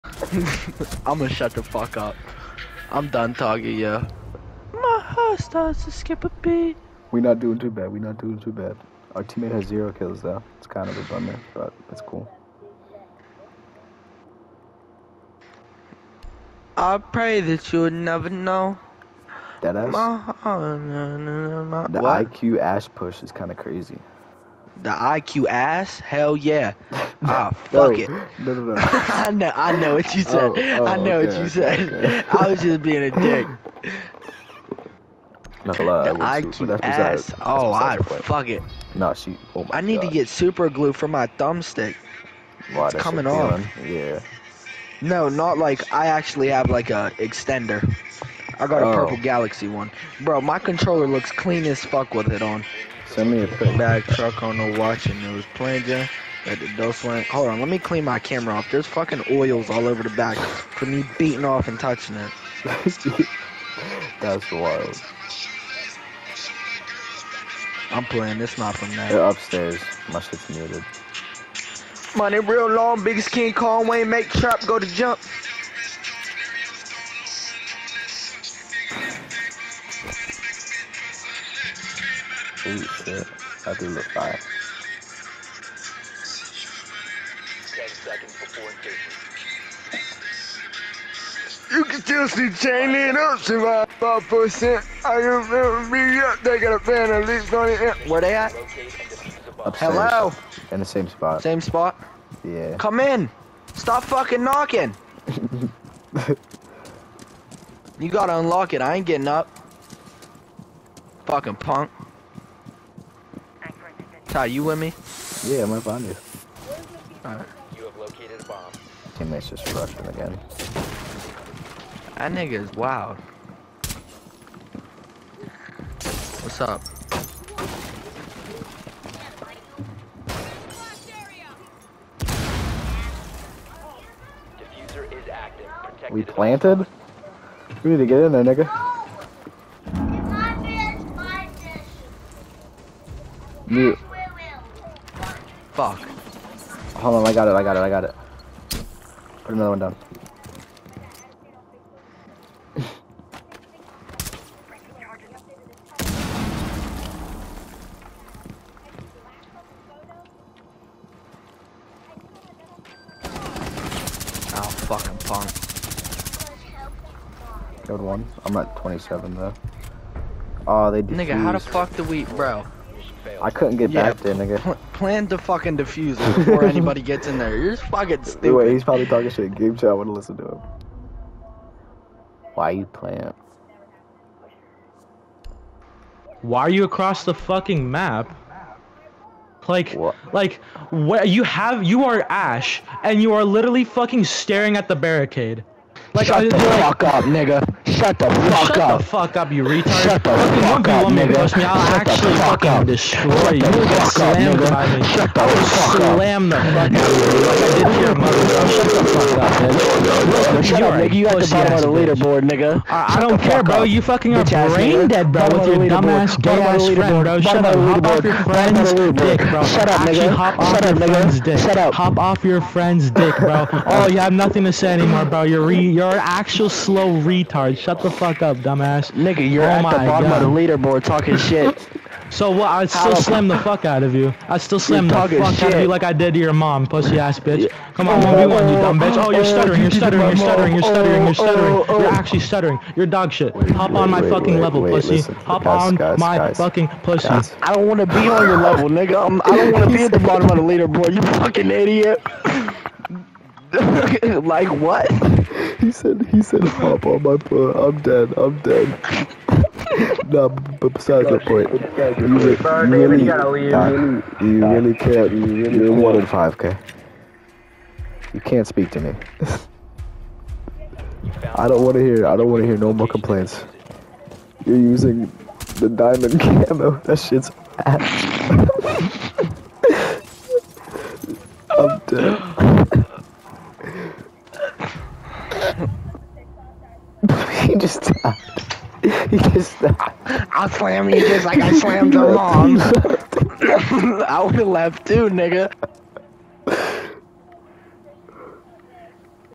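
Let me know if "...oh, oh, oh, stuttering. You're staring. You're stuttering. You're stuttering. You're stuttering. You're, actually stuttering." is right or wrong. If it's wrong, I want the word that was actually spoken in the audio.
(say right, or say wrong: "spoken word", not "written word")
wrong: "stuttering", not "staring".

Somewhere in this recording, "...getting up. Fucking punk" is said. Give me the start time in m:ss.
1:49.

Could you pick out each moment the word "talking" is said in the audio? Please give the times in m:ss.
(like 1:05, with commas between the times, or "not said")
0:03, 2:59, 3:51.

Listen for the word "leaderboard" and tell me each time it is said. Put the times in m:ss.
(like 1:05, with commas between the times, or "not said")
3:31, 3:50, 4:10.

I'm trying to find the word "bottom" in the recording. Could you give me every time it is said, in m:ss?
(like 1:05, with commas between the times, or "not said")
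3:31, 3:50, 4:10.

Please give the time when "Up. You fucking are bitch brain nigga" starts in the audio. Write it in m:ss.
3:33.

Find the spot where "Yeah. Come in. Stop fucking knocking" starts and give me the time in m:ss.
1:42.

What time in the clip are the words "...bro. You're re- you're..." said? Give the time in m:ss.
3:45.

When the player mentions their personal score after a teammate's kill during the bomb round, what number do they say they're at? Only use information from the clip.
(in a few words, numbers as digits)
27.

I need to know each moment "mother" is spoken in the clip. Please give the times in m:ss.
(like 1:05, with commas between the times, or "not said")
3:28.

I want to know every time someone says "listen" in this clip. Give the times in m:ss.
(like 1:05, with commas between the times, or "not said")
3:00.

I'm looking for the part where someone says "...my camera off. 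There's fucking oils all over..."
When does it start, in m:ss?
0:58.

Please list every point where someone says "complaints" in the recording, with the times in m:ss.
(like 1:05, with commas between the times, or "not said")
4:33.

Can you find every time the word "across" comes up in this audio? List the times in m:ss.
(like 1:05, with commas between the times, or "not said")
3:06.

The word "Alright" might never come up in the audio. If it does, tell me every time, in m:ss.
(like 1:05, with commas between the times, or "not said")
1:57.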